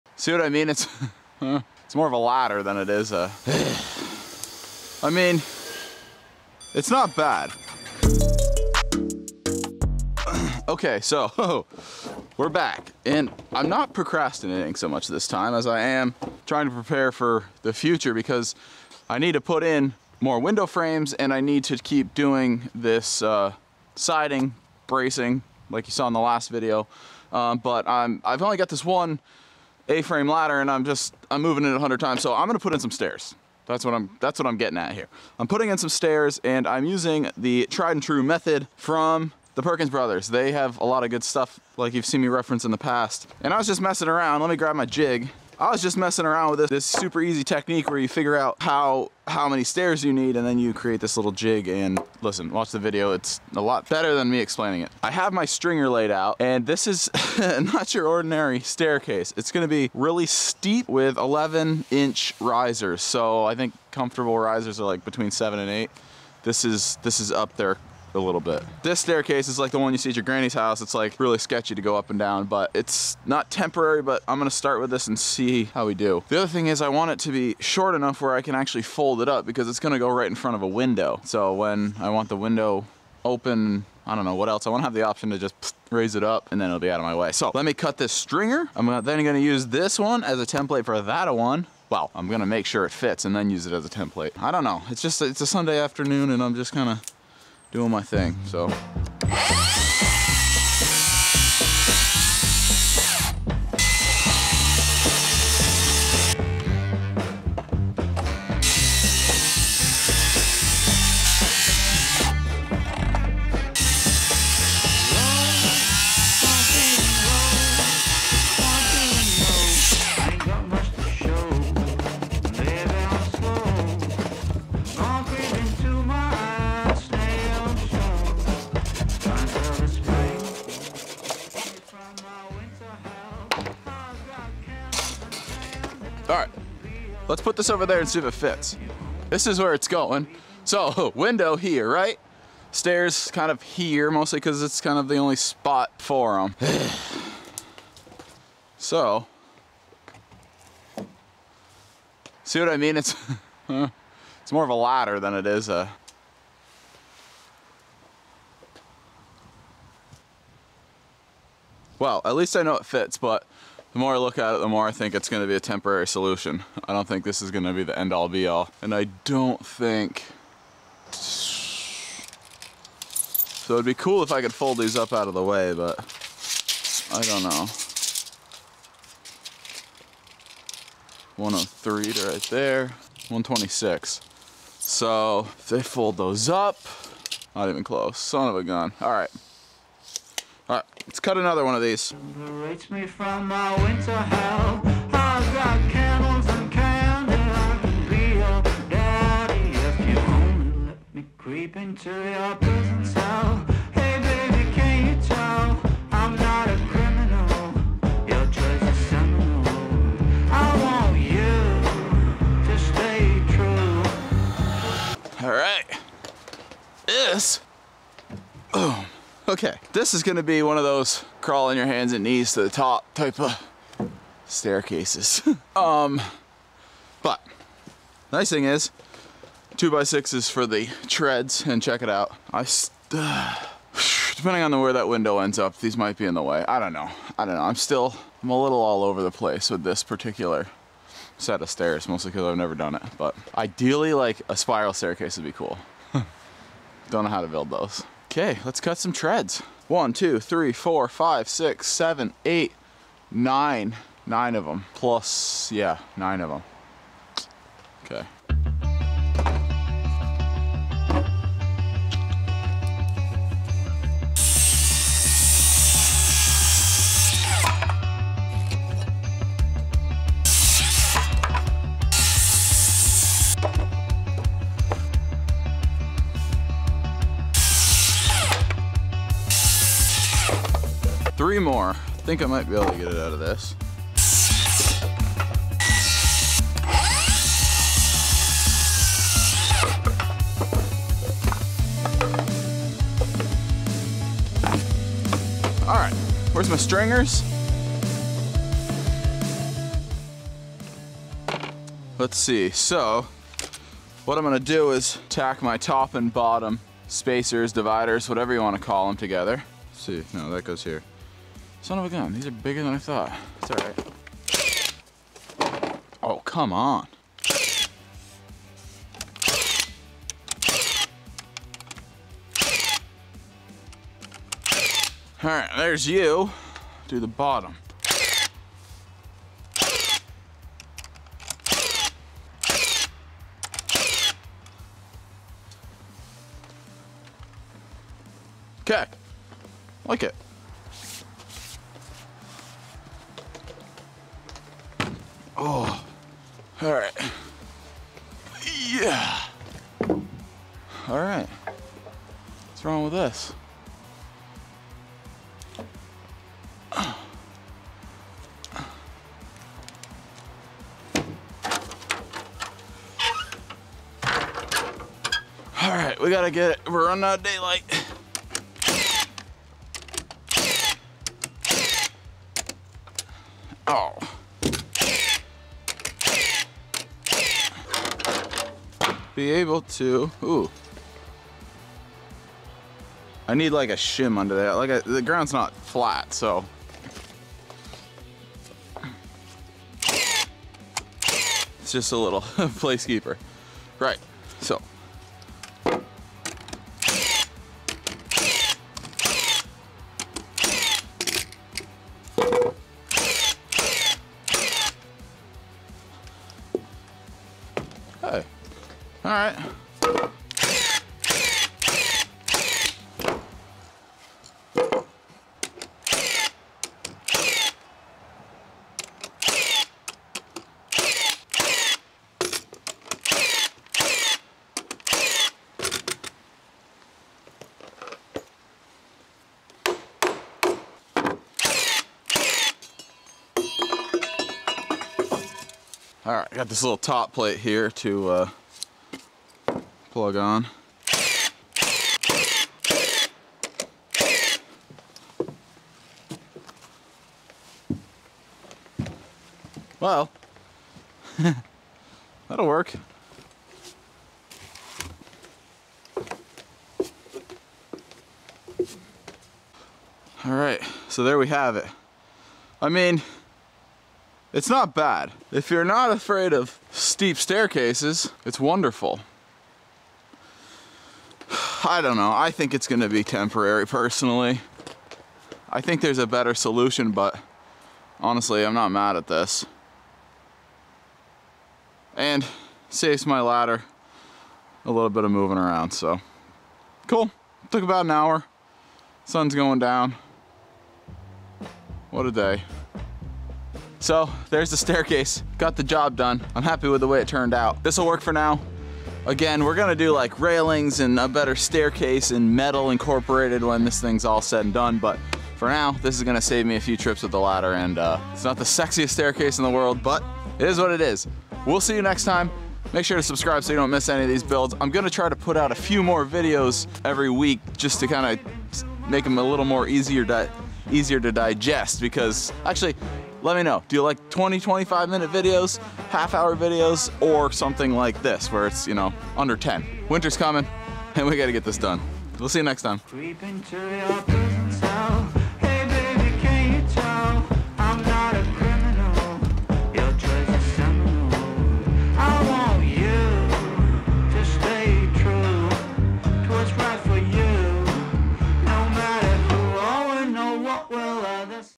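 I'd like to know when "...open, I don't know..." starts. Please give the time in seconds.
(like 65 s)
83 s.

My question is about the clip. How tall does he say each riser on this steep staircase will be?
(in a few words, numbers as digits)
11 inches.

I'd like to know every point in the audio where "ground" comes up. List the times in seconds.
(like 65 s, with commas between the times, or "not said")
385 s.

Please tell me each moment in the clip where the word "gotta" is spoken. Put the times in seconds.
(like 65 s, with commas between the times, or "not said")
366 s, 531 s.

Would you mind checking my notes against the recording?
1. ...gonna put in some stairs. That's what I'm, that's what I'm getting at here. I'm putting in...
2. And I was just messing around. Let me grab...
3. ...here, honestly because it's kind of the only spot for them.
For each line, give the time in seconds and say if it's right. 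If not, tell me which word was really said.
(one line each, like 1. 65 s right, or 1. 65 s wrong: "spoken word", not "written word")
1. 32 s right
2. 43 s right
3. 143 s wrong: "mostly", not "honestly".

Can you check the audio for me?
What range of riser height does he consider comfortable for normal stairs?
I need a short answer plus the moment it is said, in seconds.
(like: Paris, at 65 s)
7 to 8 inches, at 65 s.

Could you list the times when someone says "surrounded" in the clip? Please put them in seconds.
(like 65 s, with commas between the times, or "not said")
not said.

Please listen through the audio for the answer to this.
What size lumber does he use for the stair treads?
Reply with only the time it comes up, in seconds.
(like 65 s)
229 s.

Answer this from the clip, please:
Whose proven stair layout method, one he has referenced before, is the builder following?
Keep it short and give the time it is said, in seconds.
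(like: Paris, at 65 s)
Perkins Brothers, at 39 s.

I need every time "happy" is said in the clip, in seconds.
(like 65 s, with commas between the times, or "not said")
496 s.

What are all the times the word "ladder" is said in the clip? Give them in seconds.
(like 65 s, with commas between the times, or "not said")
2 s, 30 s, 154 s, 483 s, 507 s.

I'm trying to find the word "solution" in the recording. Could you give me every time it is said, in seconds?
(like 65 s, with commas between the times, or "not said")
166 s, 476 s.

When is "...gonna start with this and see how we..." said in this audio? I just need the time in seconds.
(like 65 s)
74 s.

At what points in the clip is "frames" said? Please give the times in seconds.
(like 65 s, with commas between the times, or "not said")
20 s, 29 s.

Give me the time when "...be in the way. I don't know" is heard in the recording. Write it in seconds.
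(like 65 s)
236 s.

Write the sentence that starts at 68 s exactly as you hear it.
This staircase is like the one you see at your granny's house.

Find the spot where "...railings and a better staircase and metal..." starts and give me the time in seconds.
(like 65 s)
500 s.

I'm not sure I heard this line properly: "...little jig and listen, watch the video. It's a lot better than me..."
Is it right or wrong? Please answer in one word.
right.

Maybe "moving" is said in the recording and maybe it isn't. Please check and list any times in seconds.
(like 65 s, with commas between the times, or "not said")
31 s, 485 s.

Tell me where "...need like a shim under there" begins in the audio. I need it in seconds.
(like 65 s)
383 s.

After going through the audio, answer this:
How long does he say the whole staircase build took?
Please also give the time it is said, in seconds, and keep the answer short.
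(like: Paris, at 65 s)
About an hour, at 487 s.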